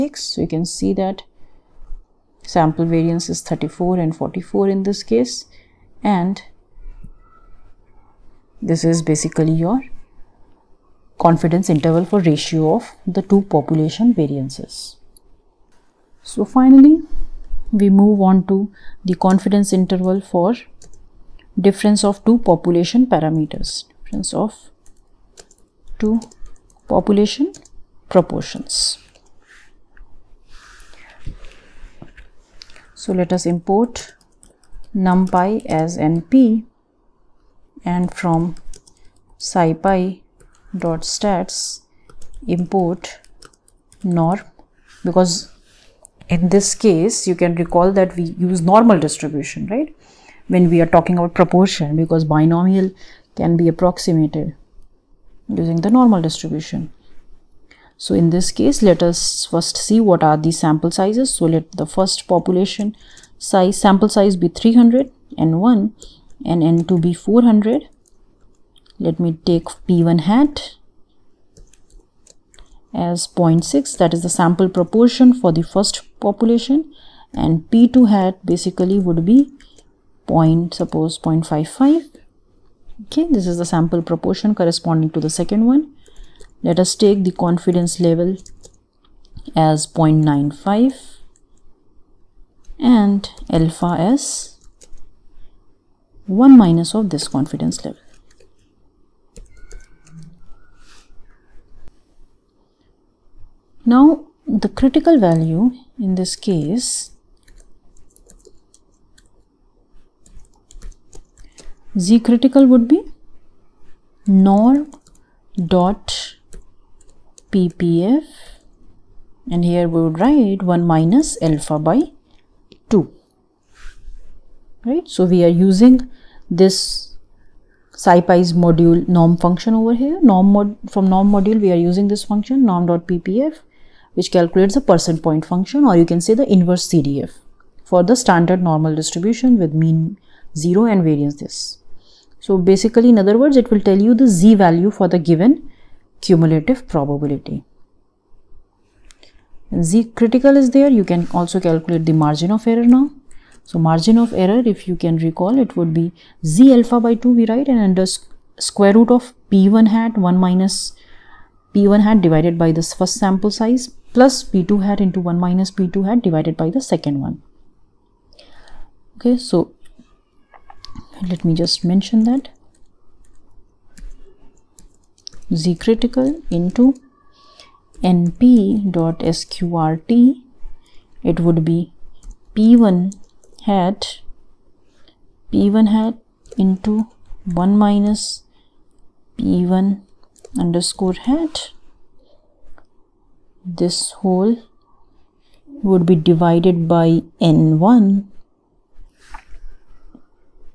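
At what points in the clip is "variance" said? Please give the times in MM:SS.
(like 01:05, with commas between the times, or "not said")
00:02, 00:14, 02:21.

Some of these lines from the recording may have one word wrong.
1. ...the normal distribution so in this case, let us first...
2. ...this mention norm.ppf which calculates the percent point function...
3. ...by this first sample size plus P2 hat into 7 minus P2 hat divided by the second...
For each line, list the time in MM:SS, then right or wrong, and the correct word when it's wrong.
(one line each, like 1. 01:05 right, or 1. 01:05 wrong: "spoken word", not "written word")
1. 00:55 right
2. 02:12 wrong: "function", not "mention"
3. 02:42 wrong: "1", not "7".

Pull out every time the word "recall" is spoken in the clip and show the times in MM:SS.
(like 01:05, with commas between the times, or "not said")
00:47, 02:35.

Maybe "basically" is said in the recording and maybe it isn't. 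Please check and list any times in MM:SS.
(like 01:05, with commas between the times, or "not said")
00:09, 01:18, 02:22.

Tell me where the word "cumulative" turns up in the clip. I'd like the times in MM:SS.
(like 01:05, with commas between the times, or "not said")
02:26.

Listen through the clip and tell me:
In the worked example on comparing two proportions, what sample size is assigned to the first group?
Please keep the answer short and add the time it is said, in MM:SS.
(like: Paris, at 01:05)
300, at 01:04.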